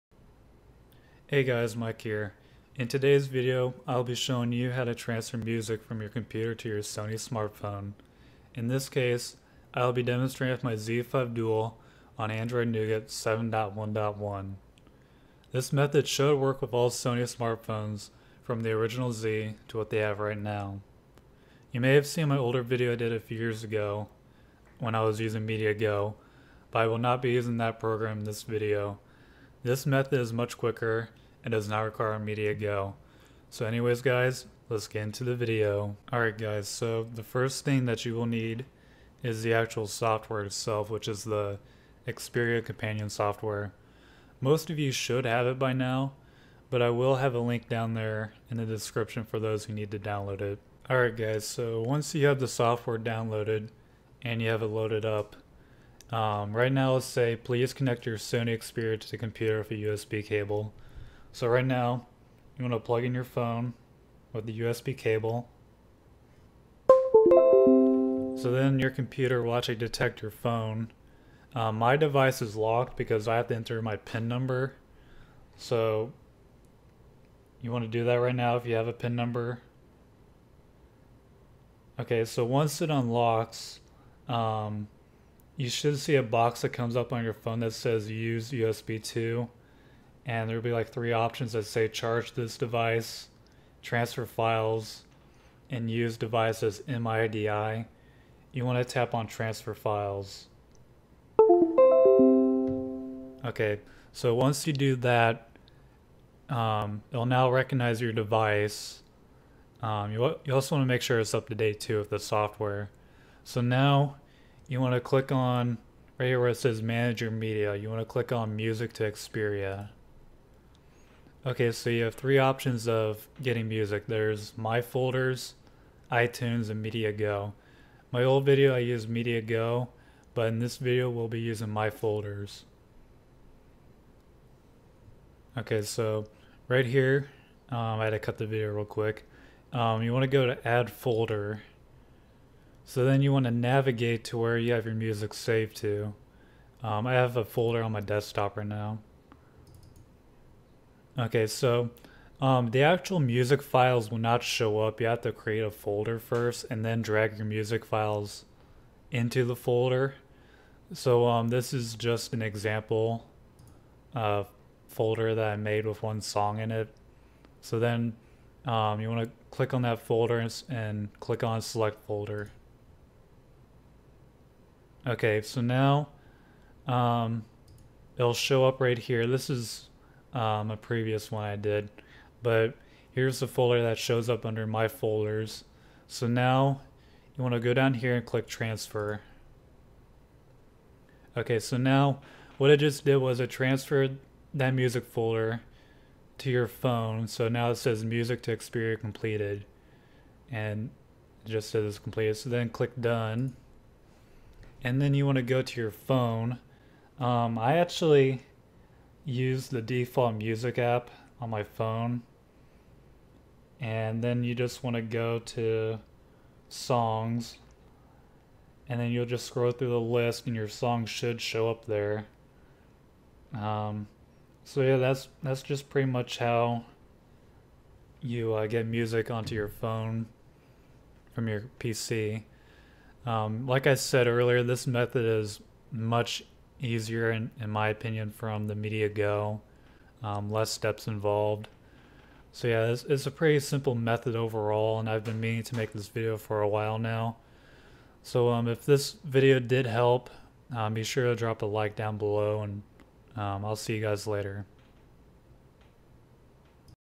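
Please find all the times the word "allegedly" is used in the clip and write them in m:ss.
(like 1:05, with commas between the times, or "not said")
not said.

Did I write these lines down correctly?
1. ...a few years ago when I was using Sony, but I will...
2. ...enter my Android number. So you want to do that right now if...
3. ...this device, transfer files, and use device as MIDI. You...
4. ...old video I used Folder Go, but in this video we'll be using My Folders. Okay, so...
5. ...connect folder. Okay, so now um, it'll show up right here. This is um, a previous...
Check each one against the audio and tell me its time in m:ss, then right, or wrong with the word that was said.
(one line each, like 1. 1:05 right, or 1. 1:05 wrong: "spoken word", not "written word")
1. 0:23 wrong: "MediaGo", not "Sony"
2. 1:13 wrong: "PIN", not "Android"
3. 1:32 right
4. 2:08 wrong: "Media", not "Folder"
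5. 2:51 wrong: "select", not "connect".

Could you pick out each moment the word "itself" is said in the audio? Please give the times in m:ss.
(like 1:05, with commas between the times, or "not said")
0:40.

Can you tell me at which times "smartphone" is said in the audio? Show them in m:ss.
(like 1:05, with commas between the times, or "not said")
0:07, 0:17.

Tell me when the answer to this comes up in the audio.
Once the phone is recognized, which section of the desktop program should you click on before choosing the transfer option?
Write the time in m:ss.
1:56.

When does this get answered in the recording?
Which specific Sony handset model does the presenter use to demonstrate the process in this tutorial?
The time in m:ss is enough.
0:10.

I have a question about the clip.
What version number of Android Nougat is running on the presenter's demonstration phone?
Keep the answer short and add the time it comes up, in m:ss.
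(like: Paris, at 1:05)
7.1.1, at 0:13.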